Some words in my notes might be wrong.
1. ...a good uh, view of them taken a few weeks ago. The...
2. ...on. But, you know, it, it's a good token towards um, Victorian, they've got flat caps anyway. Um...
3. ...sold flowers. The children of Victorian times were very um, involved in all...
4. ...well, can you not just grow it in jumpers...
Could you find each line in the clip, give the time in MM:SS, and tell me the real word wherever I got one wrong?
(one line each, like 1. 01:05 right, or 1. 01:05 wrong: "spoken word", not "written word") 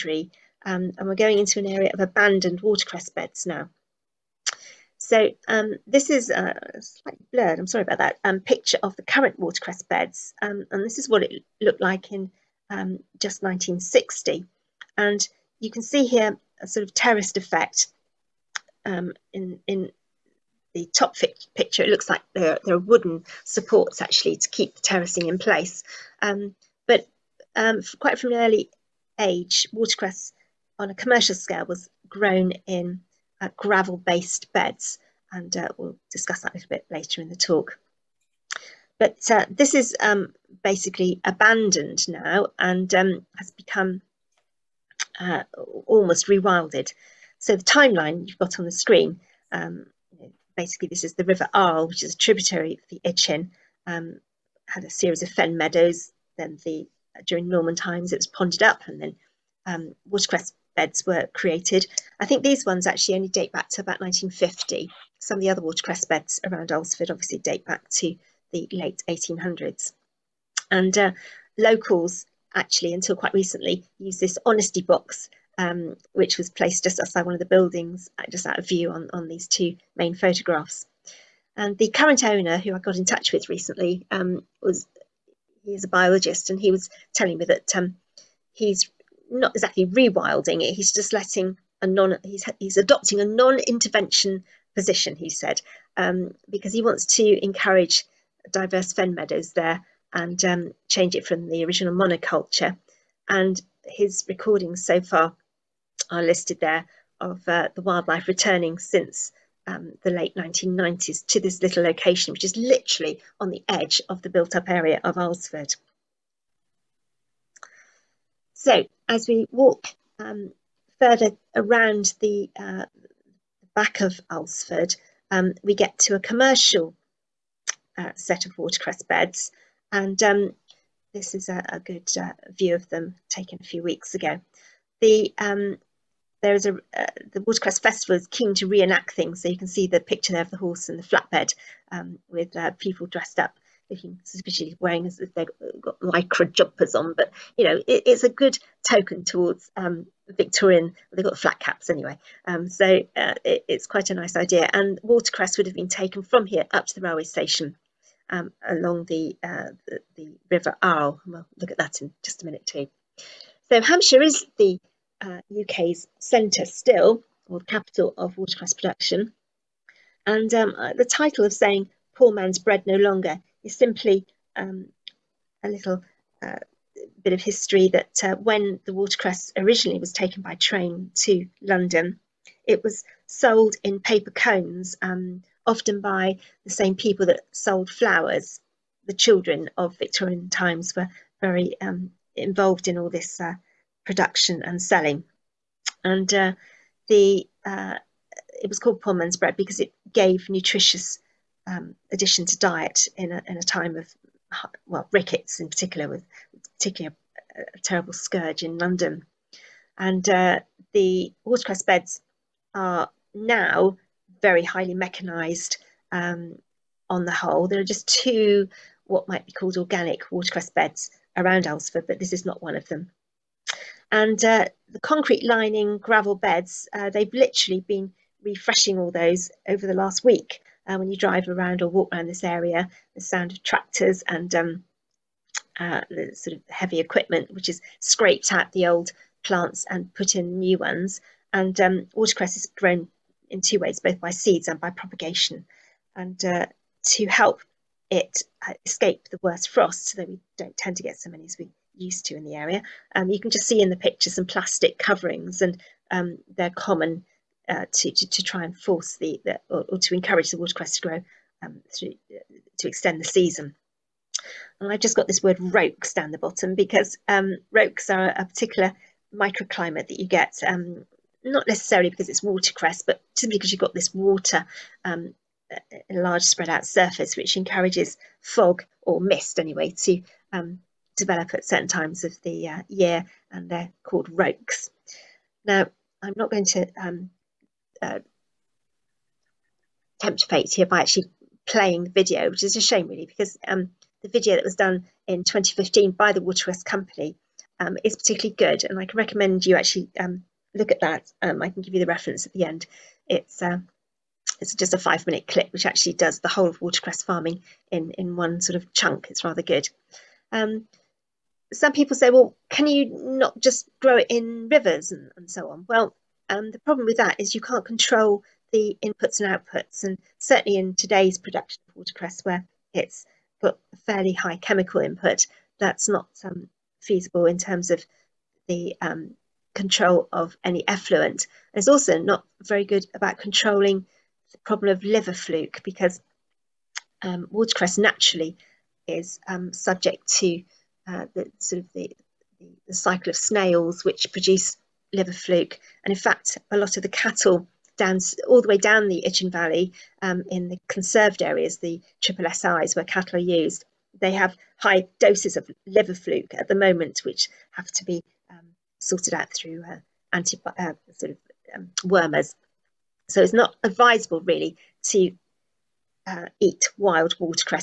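1. 02:11 right
2. 02:26 right
3. 03:07 right
4. 05:12 wrong: "rivers", not "jumpers".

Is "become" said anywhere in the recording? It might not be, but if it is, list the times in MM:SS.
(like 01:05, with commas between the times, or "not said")
00:43.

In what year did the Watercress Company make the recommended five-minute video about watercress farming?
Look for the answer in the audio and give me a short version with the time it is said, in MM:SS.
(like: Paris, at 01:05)
2015, at 04:55.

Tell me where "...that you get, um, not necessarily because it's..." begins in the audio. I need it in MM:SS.
04:30.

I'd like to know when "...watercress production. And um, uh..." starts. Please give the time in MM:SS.
02:48.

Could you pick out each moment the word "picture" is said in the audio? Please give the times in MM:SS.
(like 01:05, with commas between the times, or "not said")
00:08, 00:21, 02:20, 04:13.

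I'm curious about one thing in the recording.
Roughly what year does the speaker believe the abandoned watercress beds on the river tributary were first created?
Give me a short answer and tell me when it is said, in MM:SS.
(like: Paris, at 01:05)
1950, at 01:03.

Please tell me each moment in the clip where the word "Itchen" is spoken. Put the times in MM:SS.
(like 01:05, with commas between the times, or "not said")
00:53, 05:49.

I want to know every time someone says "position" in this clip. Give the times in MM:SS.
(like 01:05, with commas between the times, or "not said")
01:34.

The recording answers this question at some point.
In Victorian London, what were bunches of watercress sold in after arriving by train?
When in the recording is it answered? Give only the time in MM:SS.
03:03.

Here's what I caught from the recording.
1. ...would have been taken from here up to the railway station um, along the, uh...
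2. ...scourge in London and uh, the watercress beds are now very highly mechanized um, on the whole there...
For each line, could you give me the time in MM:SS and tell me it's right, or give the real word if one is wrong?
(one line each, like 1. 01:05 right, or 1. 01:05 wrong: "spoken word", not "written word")
1. 02:35 right
2. 03:28 right.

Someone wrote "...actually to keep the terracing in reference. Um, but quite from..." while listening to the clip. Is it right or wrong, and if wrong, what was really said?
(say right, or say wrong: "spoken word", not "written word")
wrong: "place", not "reference".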